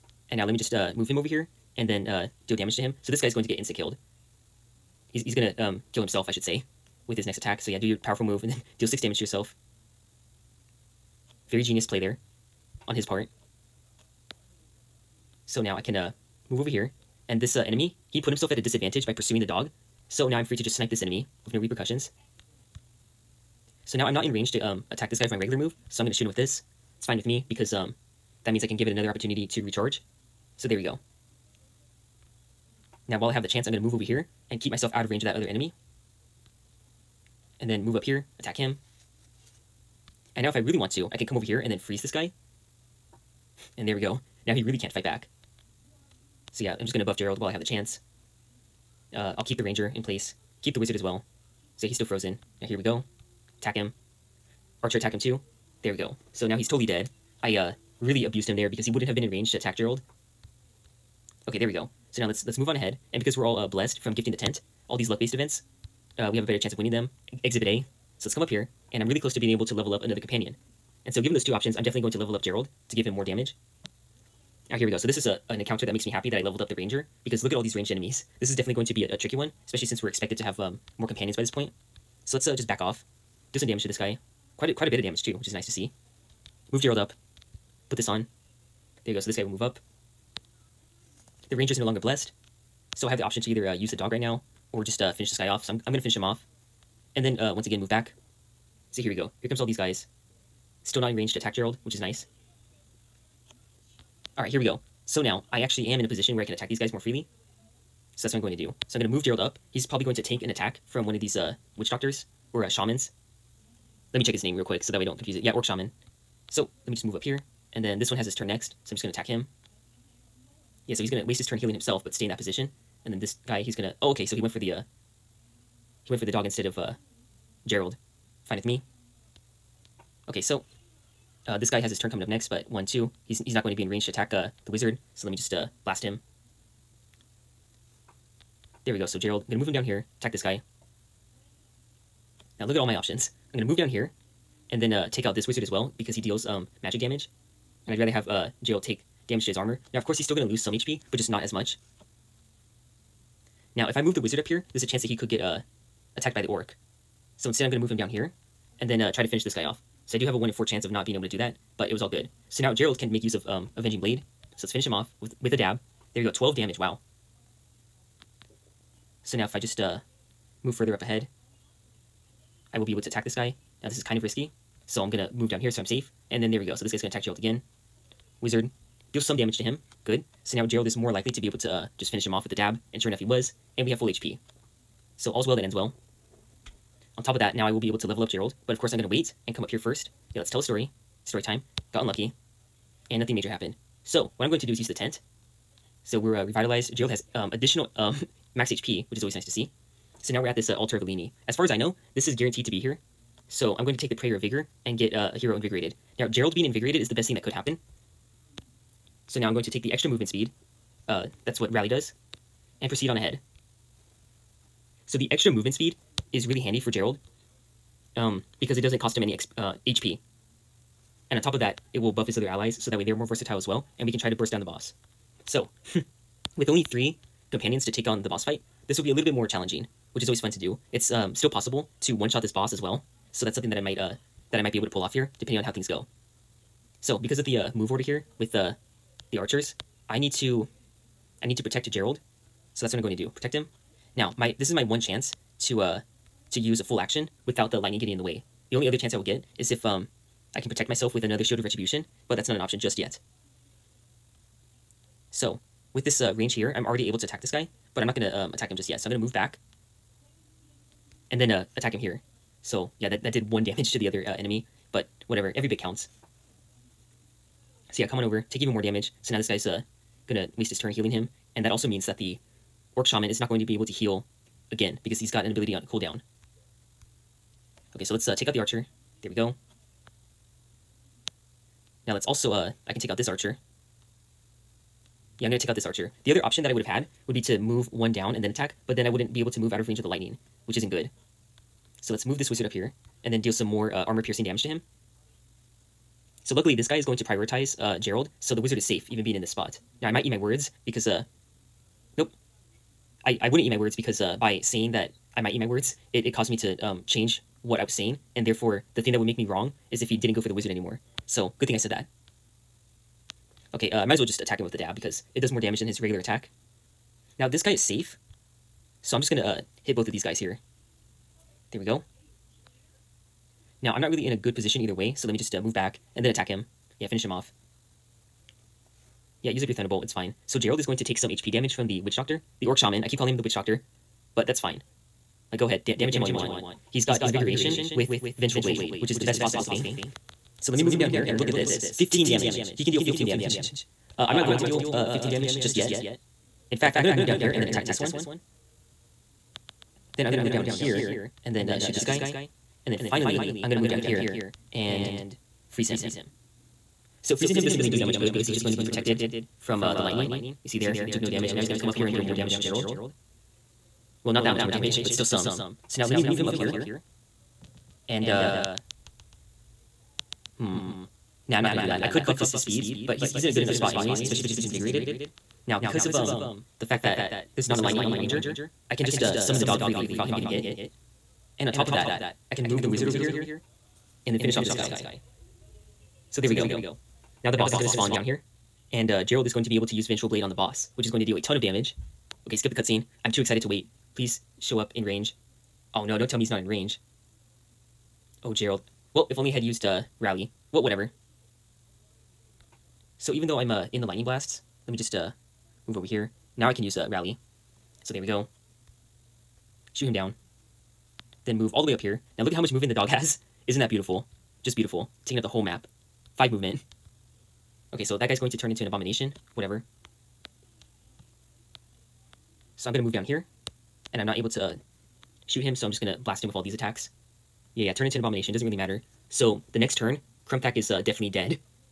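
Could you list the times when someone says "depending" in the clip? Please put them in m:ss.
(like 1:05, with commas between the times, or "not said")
3:55.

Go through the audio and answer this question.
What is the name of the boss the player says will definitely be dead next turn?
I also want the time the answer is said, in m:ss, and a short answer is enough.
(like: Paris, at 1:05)
Krumthak, at 7:10.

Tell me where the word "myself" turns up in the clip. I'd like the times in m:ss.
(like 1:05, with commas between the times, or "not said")
0:34, 4:10.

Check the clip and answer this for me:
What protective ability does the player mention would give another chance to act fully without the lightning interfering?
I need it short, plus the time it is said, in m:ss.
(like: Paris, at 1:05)
Shield of Retribution, at 4:11.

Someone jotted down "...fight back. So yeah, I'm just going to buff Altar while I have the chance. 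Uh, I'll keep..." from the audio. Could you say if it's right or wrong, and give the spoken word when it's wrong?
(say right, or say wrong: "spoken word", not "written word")
wrong: "Gerald", not "Altar".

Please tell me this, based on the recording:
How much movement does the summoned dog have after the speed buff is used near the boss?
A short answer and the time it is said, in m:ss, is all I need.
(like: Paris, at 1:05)
5, at 6:56.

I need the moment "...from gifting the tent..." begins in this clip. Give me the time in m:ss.
1:03.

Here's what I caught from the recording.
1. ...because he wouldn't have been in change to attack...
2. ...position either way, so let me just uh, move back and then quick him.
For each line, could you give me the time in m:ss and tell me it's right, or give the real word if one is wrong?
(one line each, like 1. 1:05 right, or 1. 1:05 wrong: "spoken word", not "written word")
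1. 0:58 wrong: "range", not "change"
2. 5:24 wrong: "attack", not "quick".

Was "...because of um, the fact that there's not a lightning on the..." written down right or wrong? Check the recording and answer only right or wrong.
right.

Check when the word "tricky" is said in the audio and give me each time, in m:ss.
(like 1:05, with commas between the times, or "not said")
1:19.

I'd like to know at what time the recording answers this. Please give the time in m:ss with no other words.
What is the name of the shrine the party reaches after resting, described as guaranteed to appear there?
3:20.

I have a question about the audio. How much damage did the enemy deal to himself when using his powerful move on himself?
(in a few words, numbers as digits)
6.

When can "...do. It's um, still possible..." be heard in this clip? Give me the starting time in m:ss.
3:50.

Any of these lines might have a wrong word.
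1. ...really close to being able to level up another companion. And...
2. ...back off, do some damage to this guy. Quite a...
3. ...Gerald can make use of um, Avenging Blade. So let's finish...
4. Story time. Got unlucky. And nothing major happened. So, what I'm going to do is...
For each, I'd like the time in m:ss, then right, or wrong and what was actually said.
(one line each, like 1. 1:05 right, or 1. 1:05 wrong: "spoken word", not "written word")
1. 1:09 right
2. 1:22 right
3. 2:42 right
4. 3:11 right.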